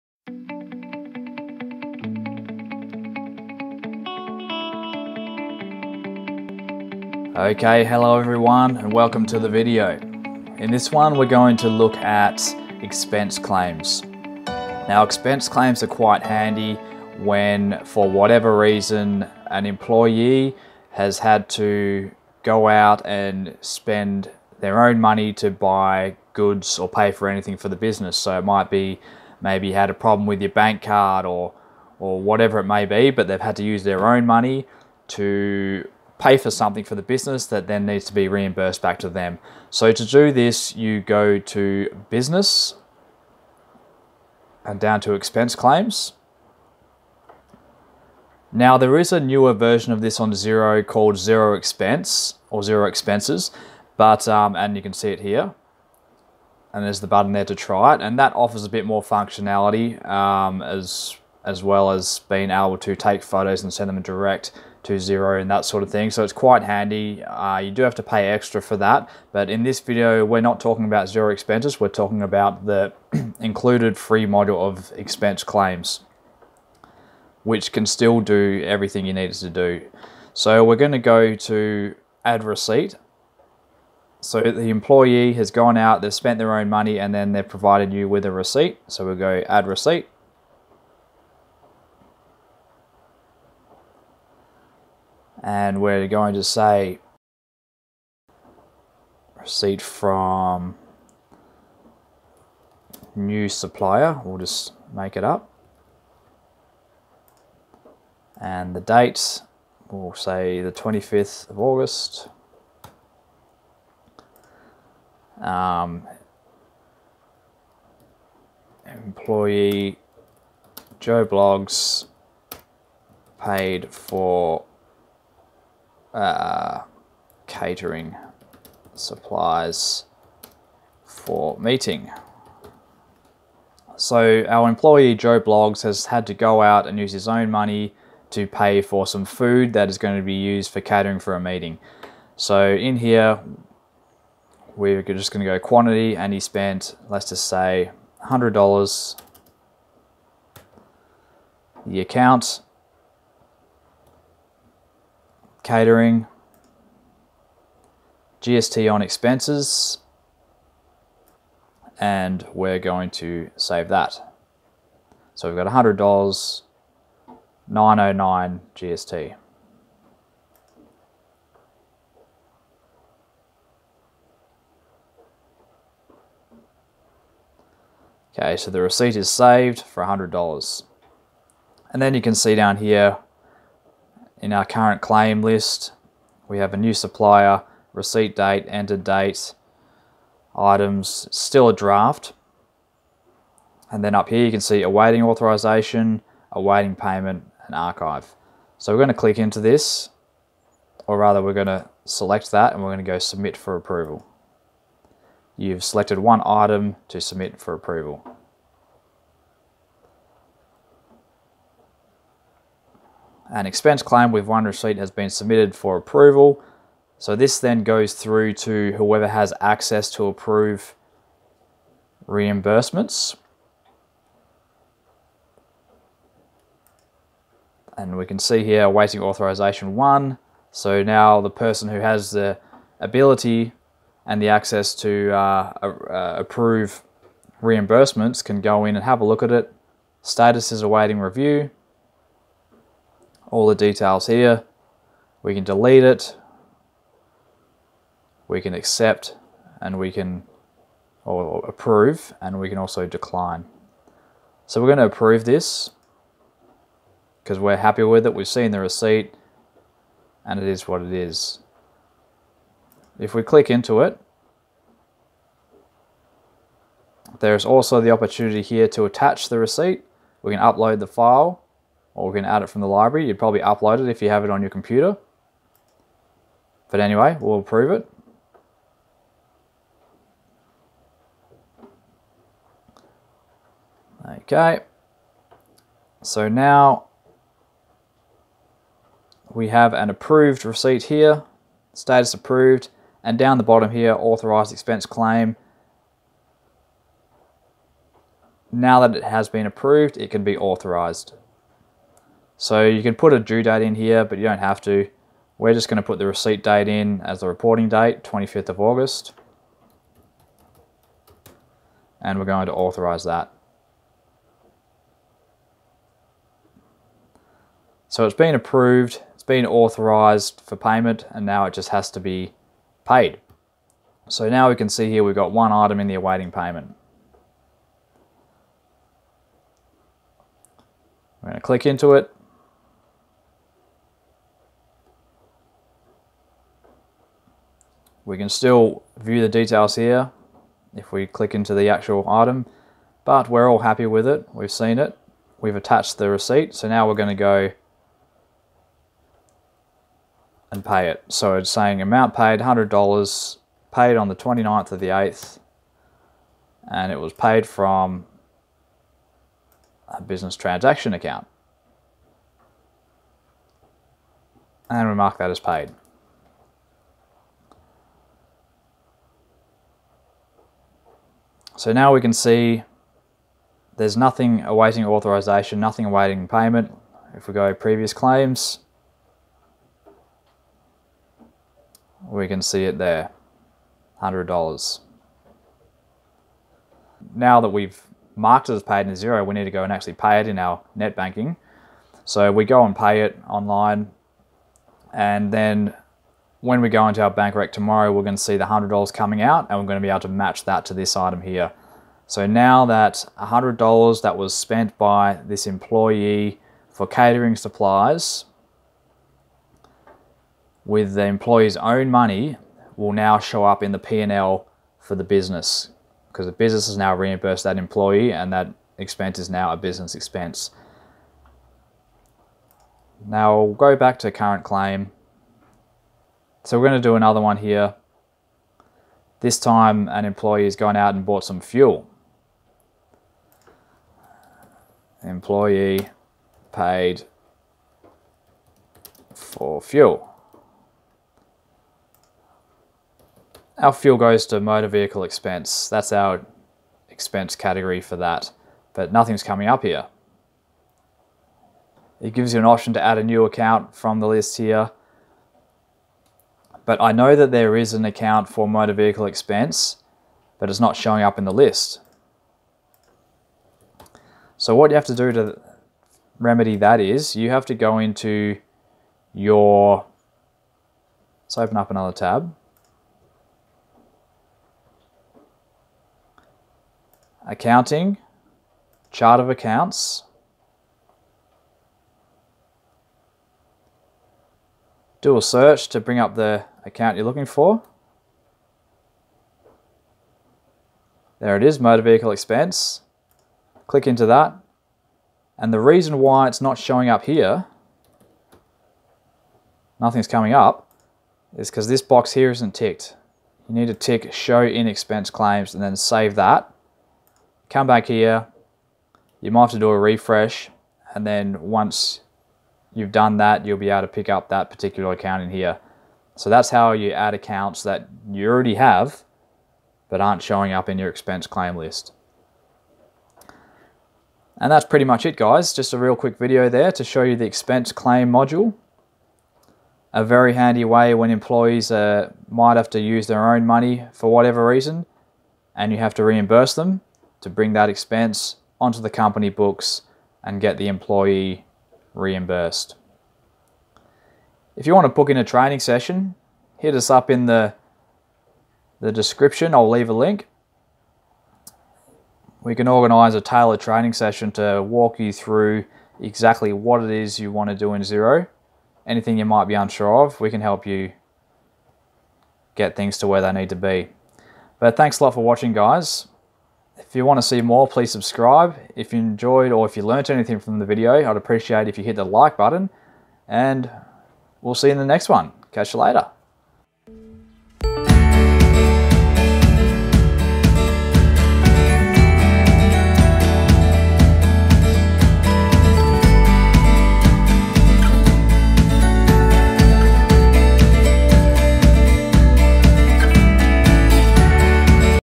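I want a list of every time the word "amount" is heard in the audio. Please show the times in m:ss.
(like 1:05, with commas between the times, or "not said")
5:52.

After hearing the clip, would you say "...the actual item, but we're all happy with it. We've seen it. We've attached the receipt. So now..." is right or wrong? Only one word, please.
right.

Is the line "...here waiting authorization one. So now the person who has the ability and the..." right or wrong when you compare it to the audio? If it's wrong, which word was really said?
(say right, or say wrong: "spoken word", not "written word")
right.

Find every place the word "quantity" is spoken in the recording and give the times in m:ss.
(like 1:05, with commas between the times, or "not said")
2:25.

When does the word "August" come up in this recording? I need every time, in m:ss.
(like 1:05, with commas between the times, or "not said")
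1:51, 5:08.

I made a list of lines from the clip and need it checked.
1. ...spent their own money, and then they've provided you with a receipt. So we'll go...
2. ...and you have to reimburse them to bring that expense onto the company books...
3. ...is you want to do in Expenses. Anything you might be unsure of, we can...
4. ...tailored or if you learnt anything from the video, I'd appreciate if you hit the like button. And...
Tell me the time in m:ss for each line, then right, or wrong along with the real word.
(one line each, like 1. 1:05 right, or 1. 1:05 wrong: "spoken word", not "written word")
1. 1:26 right
2. 8:55 right
3. 9:17 wrong: "Xero", not "Expenses"
4. 9:29 wrong: "enjoyed", not "tailored".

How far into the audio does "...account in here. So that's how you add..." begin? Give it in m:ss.
8:35.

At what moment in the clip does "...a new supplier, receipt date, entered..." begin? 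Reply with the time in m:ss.
3:06.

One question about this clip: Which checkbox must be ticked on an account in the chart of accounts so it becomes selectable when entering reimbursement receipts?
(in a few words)
Show in expense claims.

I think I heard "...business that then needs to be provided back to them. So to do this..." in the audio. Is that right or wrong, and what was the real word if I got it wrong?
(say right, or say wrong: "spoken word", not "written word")
wrong: "reimbursed", not "provided".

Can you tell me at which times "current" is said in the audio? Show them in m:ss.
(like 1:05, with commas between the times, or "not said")
3:04, 7:04.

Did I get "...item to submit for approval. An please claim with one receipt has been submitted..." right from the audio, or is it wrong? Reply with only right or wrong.
wrong.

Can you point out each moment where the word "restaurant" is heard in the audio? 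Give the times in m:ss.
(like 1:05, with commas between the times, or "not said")
not said.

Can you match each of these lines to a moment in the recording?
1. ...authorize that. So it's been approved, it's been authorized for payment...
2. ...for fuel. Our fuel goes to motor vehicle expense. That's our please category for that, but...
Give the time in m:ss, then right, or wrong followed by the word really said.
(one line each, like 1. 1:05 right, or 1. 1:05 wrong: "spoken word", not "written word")
1. 5:12 right
2. 7:19 wrong: "expense", not "please".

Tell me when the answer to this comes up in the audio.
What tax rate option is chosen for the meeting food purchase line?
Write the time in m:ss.
2:38.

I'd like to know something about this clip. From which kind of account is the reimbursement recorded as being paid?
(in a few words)
Business transaction account.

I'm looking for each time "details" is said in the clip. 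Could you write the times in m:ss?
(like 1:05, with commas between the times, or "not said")
4:03, 5:39.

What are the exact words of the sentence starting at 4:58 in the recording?
Now that it has been approved, it can be authorized.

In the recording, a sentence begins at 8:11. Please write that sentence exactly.
There it is, motor vehicle expense.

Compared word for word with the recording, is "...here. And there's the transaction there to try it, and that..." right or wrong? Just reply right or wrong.
wrong.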